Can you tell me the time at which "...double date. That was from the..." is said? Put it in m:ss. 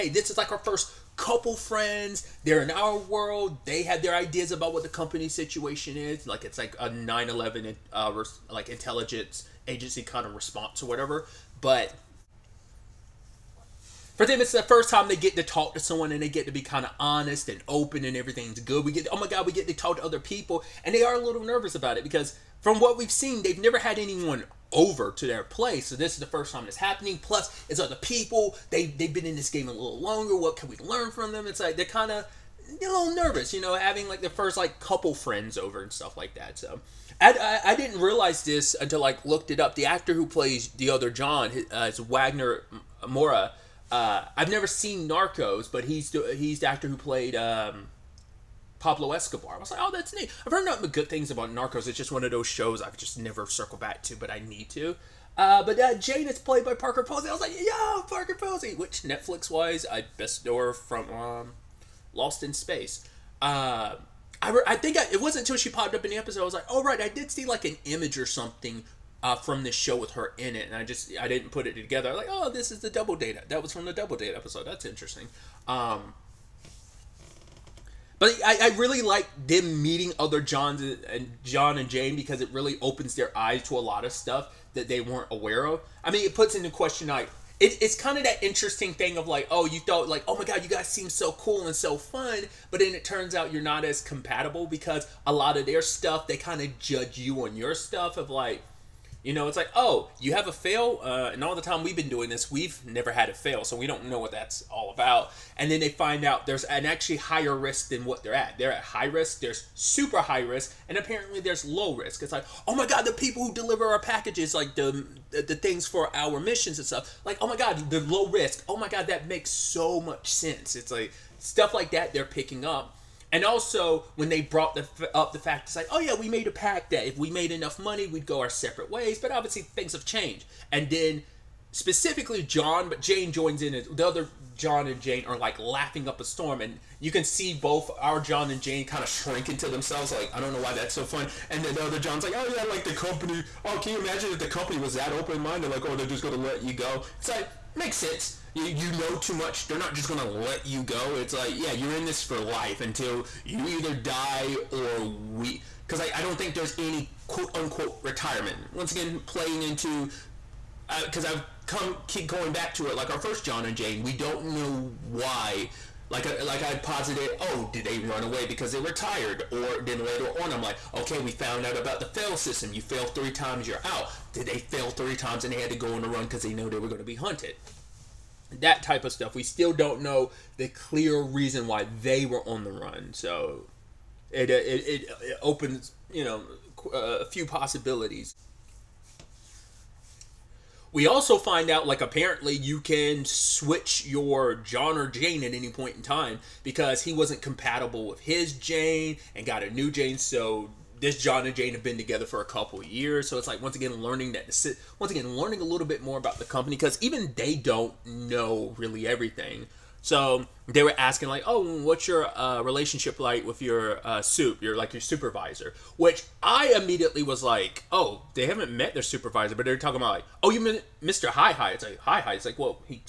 1:12.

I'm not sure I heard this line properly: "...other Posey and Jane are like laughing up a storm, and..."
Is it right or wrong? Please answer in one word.
wrong.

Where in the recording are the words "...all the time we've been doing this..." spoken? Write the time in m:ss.
1:41.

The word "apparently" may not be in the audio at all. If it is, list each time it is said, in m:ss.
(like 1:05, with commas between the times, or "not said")
1:50, 3:12.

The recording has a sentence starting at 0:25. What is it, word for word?
So this is the first time it's happening.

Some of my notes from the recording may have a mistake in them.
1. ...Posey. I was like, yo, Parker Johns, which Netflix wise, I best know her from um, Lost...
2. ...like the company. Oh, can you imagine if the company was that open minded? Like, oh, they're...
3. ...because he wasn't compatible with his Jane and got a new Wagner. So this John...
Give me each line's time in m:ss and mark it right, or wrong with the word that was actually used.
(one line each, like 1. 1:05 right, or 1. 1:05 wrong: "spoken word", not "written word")
1. 0:57 wrong: "Posey", not "Johns"
2. 2:22 right
3. 3:16 wrong: "Jane", not "Wagner".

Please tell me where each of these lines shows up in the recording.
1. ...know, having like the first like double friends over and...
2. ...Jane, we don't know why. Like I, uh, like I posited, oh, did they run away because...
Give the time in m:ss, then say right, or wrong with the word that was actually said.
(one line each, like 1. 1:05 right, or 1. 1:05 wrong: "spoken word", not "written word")
1. 0:33 wrong: "couple", not "double"
2. 2:43 right.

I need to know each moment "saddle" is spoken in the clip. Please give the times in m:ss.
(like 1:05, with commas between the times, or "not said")
not said.